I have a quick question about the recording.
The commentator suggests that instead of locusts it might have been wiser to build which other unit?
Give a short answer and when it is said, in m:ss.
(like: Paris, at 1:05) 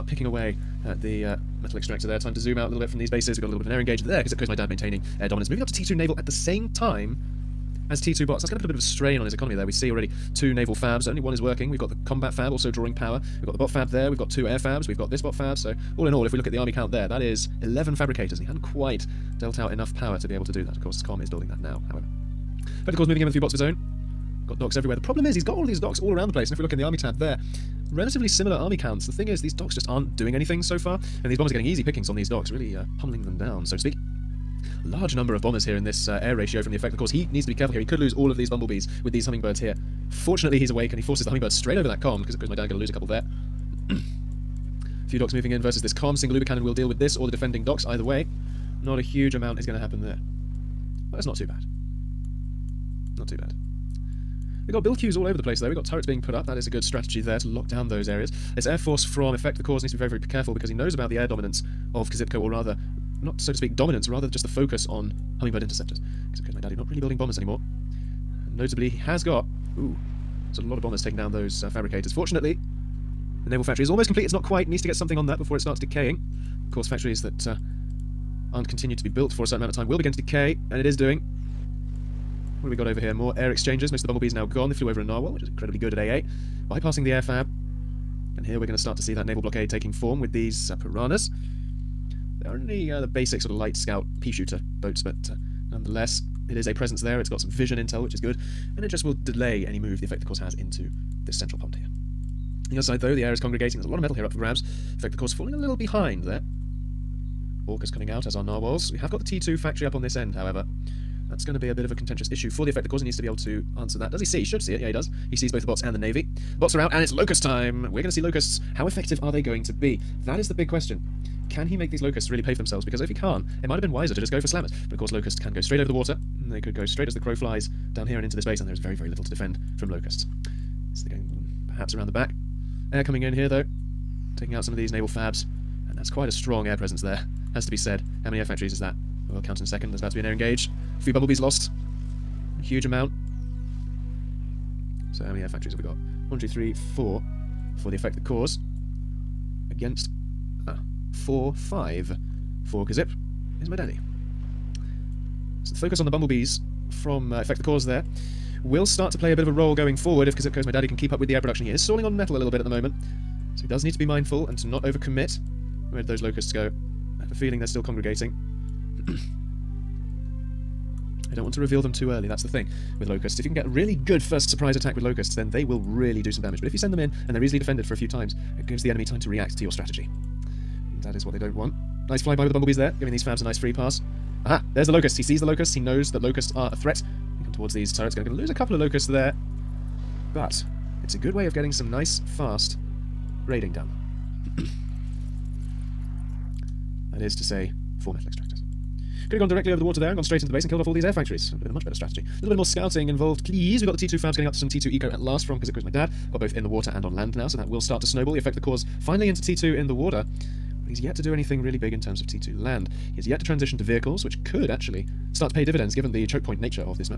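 slammers, at 2:04.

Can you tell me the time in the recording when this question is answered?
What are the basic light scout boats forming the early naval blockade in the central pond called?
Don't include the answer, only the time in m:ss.
1:30.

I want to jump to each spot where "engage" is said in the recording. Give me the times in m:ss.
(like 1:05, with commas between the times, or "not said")
0:03, 2:20.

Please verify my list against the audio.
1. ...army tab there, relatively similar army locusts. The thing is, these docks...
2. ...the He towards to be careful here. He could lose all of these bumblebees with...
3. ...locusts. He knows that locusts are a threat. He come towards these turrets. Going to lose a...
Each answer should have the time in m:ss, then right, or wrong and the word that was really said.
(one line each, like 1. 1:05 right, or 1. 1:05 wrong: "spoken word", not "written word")
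1. 0:26 wrong: "counts", not "locusts"
2. 0:36 wrong: "needs", not "towards"
3. 3:05 right.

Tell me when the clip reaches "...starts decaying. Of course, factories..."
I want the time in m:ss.
1:15.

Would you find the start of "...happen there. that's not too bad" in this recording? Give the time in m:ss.
0:49.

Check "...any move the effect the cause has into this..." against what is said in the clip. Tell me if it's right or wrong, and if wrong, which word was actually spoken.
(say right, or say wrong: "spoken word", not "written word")
right.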